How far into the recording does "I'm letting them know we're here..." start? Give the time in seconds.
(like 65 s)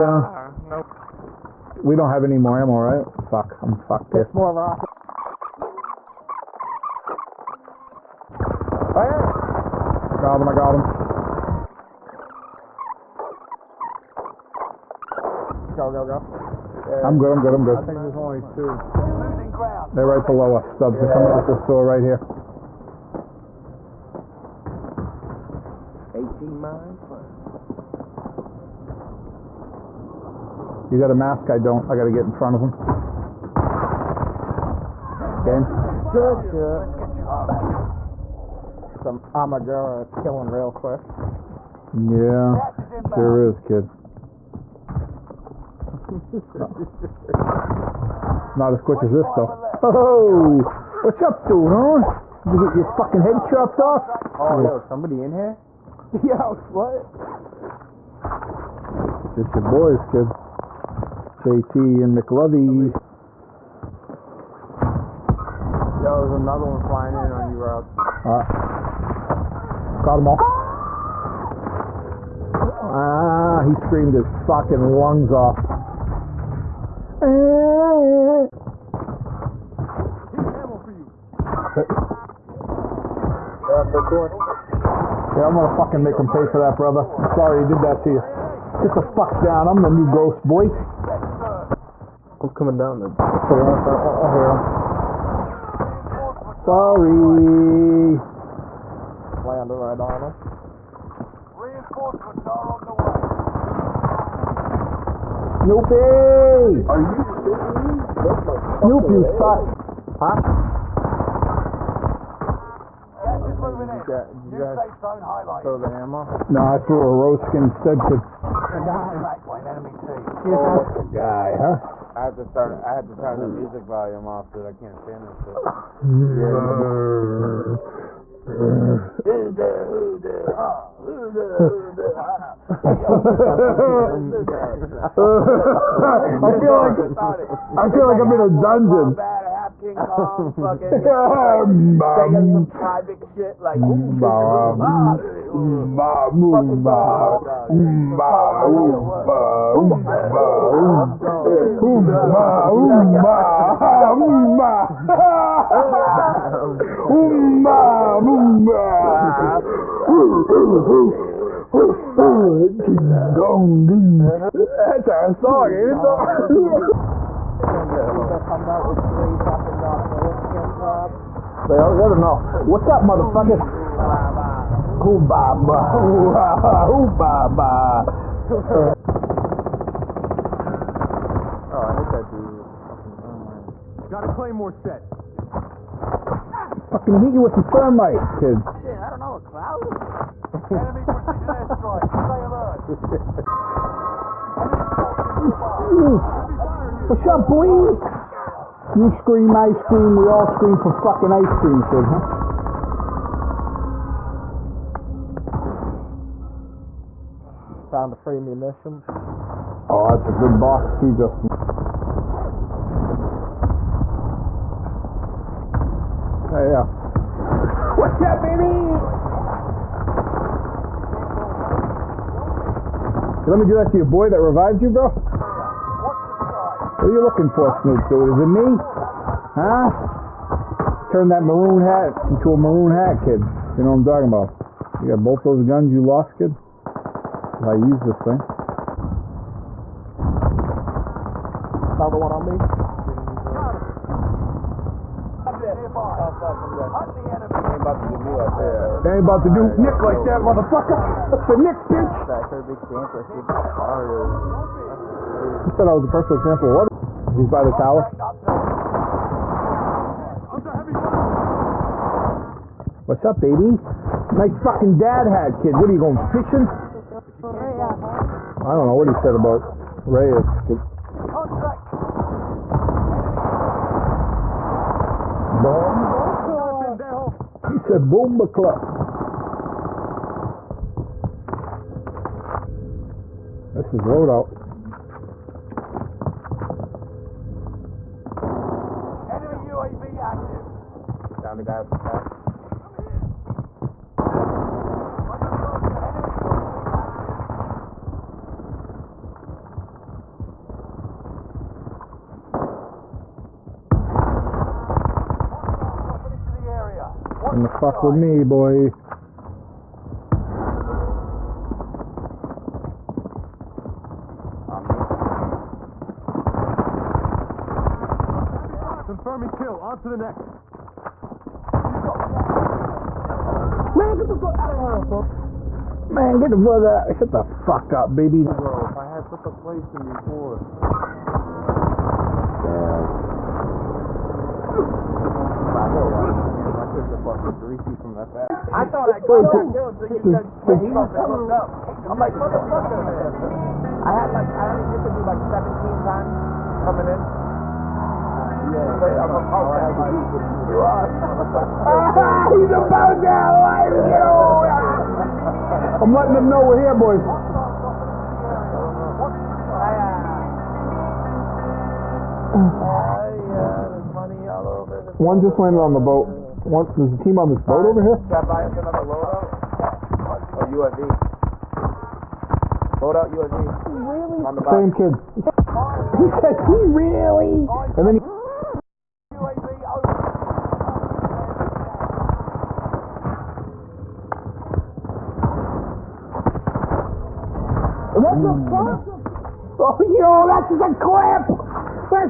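356 s.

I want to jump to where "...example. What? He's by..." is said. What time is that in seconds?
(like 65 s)
256 s.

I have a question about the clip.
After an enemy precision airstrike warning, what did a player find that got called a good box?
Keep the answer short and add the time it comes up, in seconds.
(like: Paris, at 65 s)
Free munitions, at 208 s.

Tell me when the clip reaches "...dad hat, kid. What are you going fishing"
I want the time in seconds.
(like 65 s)
264 s.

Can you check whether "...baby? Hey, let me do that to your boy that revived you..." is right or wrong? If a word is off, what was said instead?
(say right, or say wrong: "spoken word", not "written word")
right.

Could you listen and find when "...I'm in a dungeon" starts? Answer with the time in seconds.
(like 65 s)
138 s.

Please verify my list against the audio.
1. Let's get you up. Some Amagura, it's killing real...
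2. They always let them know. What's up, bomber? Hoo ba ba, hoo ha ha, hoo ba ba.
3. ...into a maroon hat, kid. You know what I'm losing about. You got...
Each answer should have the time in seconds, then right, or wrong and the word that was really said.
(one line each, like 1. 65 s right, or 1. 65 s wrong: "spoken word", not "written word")
1. 36 s right
2. 171 s wrong: "motherfucker", not "bomber"
3. 232 s wrong: "talking", not "losing".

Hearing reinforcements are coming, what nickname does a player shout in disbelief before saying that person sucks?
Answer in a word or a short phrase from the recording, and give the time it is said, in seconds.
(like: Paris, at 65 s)
Snoopy, at 105 s.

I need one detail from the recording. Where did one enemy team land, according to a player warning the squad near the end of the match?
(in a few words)
On the boat.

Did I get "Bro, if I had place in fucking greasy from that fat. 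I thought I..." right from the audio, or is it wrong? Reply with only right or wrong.
right.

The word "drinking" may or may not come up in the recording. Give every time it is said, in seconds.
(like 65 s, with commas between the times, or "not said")
not said.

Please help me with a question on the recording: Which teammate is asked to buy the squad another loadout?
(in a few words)
Chad.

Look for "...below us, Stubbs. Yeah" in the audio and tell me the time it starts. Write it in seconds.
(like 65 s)
20 s.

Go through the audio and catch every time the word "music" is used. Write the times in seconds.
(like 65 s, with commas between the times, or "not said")
123 s.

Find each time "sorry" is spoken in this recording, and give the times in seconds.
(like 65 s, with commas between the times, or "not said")
87 s, 96 s.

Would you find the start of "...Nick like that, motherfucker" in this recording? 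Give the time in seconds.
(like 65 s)
249 s.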